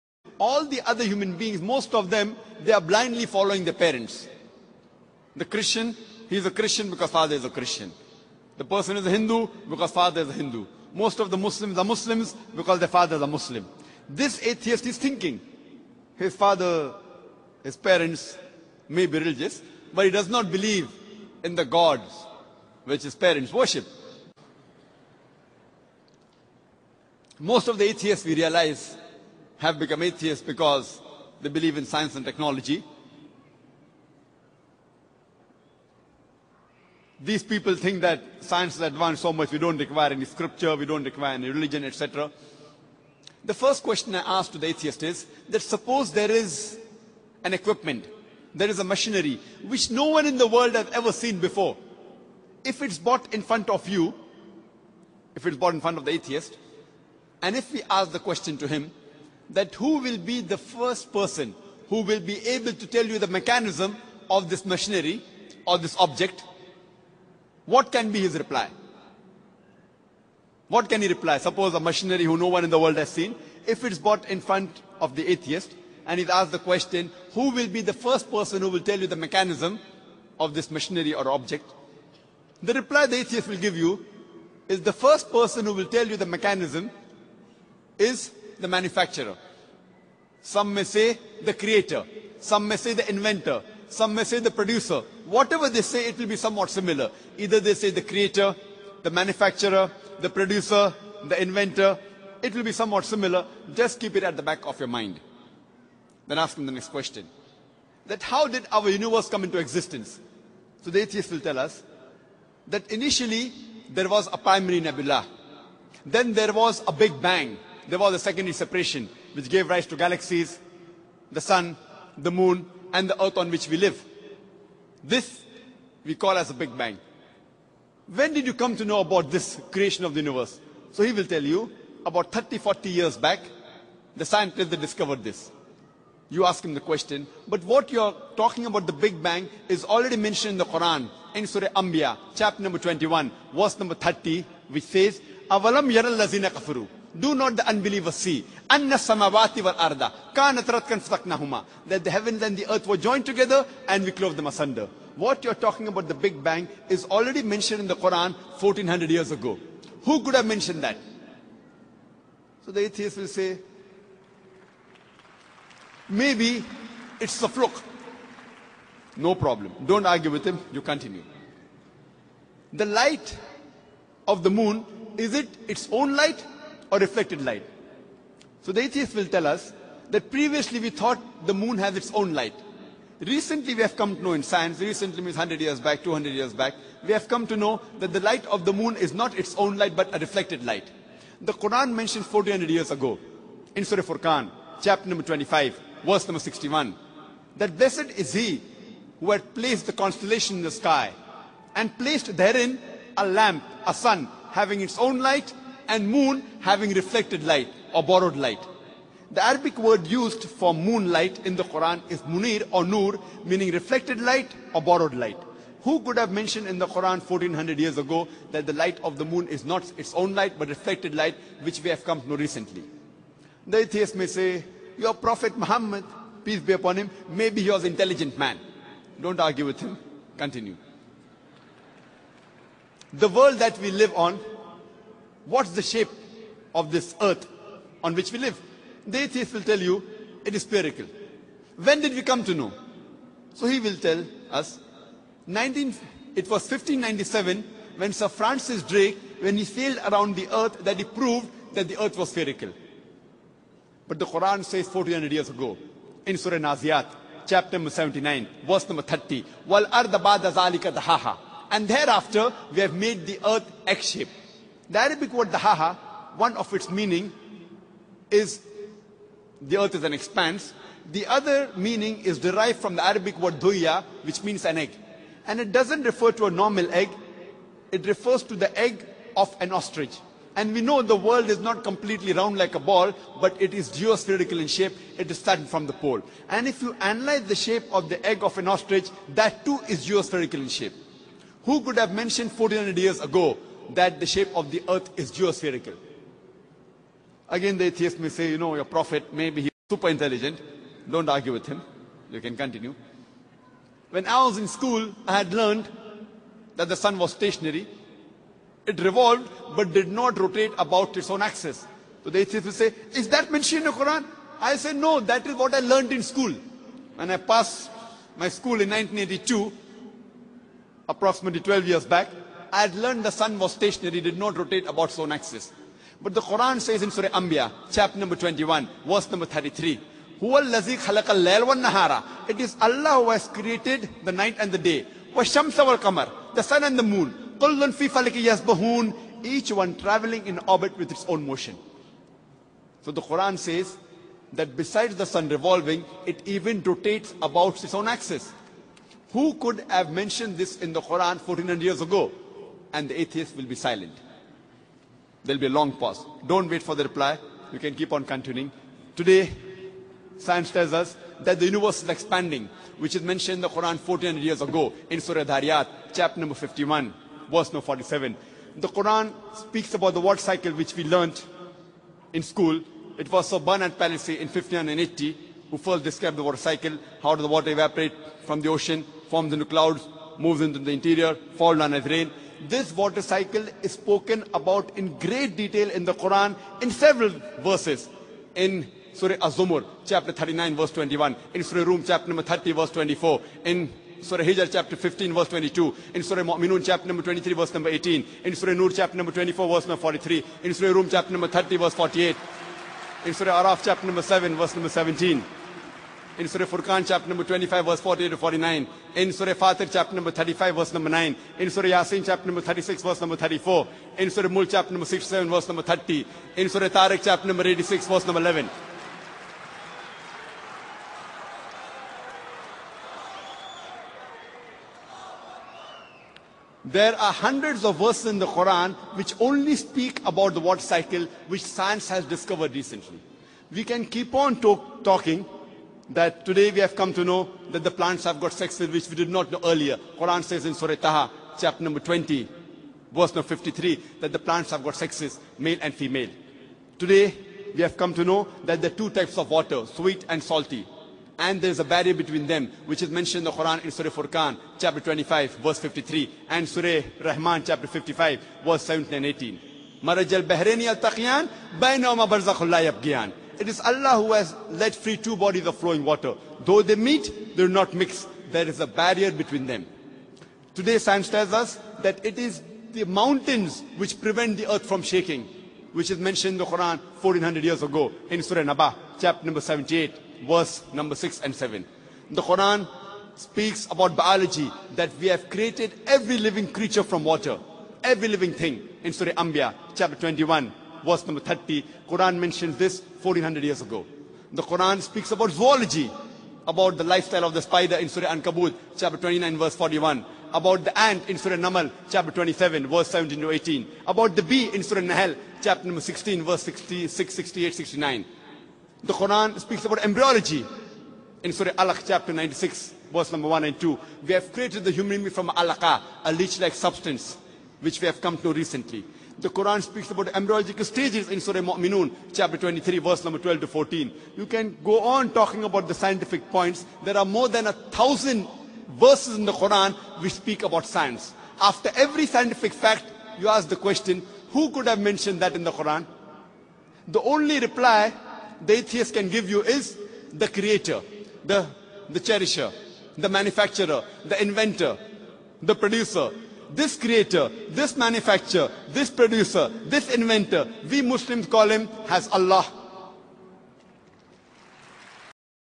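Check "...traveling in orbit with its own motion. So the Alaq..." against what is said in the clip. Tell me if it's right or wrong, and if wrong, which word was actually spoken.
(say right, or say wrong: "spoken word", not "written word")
wrong: "Quran", not "Alaq".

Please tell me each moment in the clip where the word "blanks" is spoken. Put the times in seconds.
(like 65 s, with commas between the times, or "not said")
not said.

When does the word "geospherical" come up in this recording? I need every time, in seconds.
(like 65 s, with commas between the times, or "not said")
283 s, 290 s, 295 s.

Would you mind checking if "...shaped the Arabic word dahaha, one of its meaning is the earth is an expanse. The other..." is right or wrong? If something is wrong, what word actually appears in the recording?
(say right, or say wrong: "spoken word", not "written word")
right.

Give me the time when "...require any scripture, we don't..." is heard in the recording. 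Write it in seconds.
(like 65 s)
39 s.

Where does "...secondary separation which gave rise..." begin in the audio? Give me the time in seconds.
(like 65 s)
118 s.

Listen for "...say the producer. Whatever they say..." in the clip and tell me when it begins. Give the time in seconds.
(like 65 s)
94 s.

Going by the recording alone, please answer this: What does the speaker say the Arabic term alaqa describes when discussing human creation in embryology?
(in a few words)
Leech-like substance.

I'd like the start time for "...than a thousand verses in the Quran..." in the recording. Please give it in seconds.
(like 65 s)
527 s.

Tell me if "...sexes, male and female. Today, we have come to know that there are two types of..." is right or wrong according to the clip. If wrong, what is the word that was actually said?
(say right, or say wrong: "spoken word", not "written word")
right.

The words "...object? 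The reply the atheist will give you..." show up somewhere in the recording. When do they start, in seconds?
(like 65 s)
81 s.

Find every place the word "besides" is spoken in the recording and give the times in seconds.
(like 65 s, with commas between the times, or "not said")
344 s.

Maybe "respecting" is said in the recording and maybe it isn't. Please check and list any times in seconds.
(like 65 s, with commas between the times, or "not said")
not said.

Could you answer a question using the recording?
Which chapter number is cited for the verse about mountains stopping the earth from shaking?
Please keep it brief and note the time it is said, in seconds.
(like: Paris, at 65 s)
78, at 479 s.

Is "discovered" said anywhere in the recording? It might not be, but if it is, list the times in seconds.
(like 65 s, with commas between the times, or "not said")
134 s, 432 s.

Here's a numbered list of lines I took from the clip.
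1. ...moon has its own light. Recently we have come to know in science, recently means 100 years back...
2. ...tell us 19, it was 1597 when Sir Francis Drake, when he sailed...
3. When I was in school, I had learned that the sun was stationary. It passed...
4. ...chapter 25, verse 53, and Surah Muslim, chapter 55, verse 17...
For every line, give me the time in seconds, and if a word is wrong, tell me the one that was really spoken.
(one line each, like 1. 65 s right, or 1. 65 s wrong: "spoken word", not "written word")
1. 181 s right
2. 243 s right
3. 304 s wrong: "revolved", not "passed"
4. 454 s wrong: "Rahman", not "Muslim".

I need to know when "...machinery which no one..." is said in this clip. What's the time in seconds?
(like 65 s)
48 s.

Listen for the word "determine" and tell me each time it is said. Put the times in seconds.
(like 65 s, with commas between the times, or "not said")
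not said.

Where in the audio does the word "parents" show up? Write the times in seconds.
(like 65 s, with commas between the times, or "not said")
3 s, 17 s, 23 s.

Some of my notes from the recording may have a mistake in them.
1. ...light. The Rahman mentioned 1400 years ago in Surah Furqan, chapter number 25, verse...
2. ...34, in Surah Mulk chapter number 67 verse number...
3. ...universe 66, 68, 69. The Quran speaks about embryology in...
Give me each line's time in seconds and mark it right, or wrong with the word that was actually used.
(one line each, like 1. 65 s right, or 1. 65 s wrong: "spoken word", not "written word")
1. 190 s wrong: "Quran", not "Rahman"
2. 413 s right
3. 506 s wrong: "verse", not "universe".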